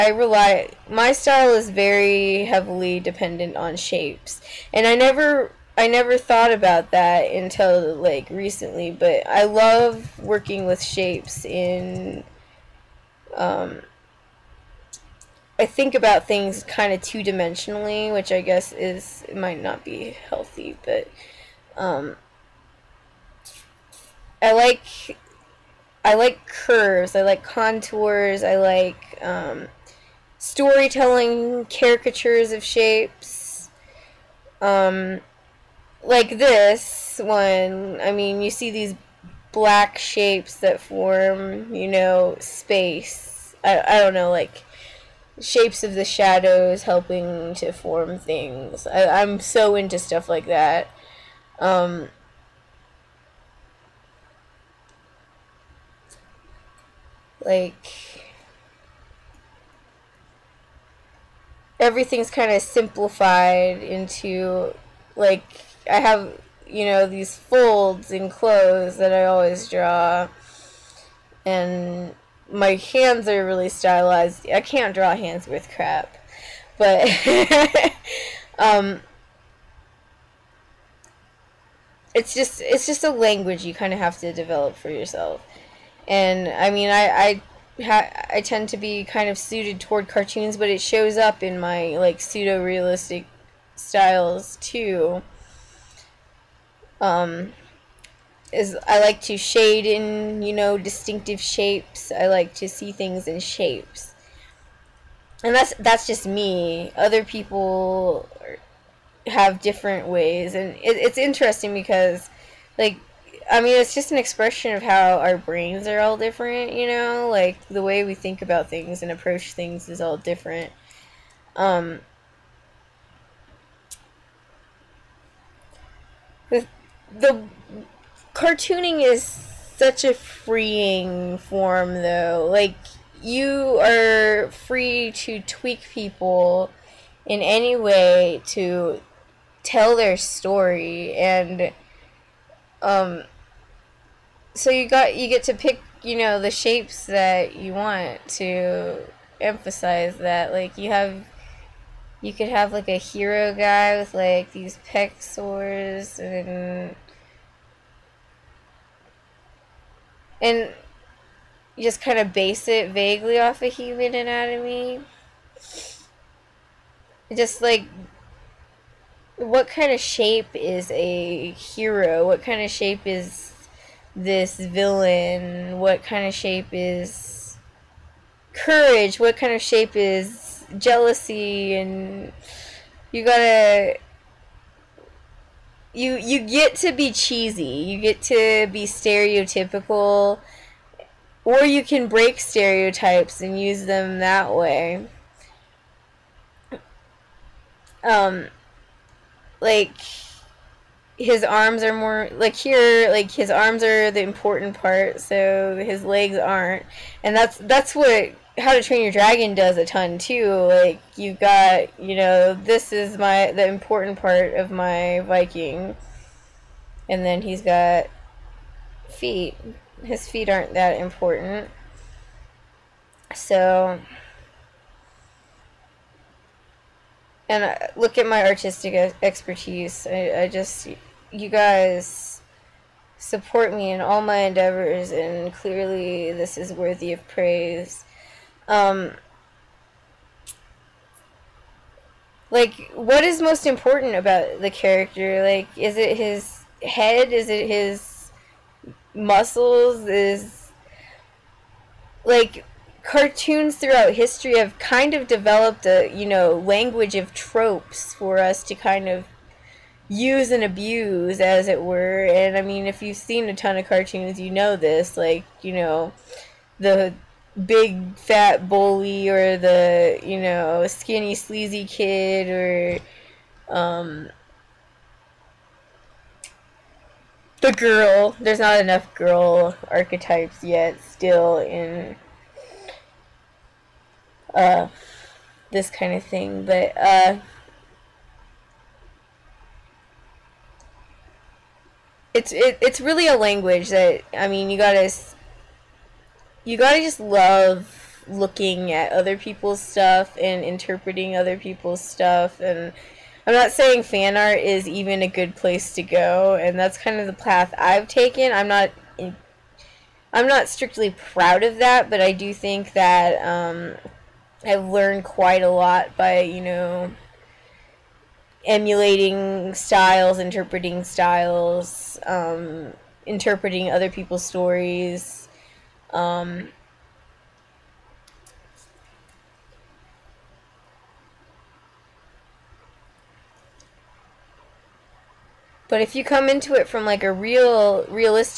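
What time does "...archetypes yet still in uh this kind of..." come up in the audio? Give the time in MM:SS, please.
04:39.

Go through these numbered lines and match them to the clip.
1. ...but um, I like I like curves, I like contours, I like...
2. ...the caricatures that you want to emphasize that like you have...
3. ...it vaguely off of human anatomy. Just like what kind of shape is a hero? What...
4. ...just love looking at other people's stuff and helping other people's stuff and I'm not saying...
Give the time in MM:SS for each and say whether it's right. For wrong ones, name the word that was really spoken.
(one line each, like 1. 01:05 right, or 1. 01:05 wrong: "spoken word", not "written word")
1. 00:20 right
2. 02:26 wrong: "shapes", not "caricatures"
3. 02:42 right
4. 04:56 wrong: "interpreting", not "helping".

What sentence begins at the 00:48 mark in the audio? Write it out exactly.
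I, am so into stuff like that.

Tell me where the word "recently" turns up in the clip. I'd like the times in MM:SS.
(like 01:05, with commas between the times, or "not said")
00:08.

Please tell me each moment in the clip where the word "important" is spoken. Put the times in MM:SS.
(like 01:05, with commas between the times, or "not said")
03:24, 03:33, 03:40, 04:03.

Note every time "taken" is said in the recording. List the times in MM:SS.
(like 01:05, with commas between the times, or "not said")
05:08.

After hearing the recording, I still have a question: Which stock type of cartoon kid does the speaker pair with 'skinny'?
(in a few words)
Sleazy.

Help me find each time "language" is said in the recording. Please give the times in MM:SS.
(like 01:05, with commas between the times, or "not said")
01:23, 04:16, 04:53.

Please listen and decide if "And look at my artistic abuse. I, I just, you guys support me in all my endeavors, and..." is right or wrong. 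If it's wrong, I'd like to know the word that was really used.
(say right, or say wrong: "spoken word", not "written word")
wrong: "expertise", not "abuse".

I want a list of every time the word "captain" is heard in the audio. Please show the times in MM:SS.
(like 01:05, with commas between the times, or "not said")
not said.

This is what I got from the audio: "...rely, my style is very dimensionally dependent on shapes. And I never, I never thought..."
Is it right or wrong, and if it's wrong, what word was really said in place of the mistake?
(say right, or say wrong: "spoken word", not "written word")
wrong: "heavily", not "dimensionally".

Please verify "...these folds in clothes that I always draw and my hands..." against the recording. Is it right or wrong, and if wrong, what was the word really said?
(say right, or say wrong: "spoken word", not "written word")
right.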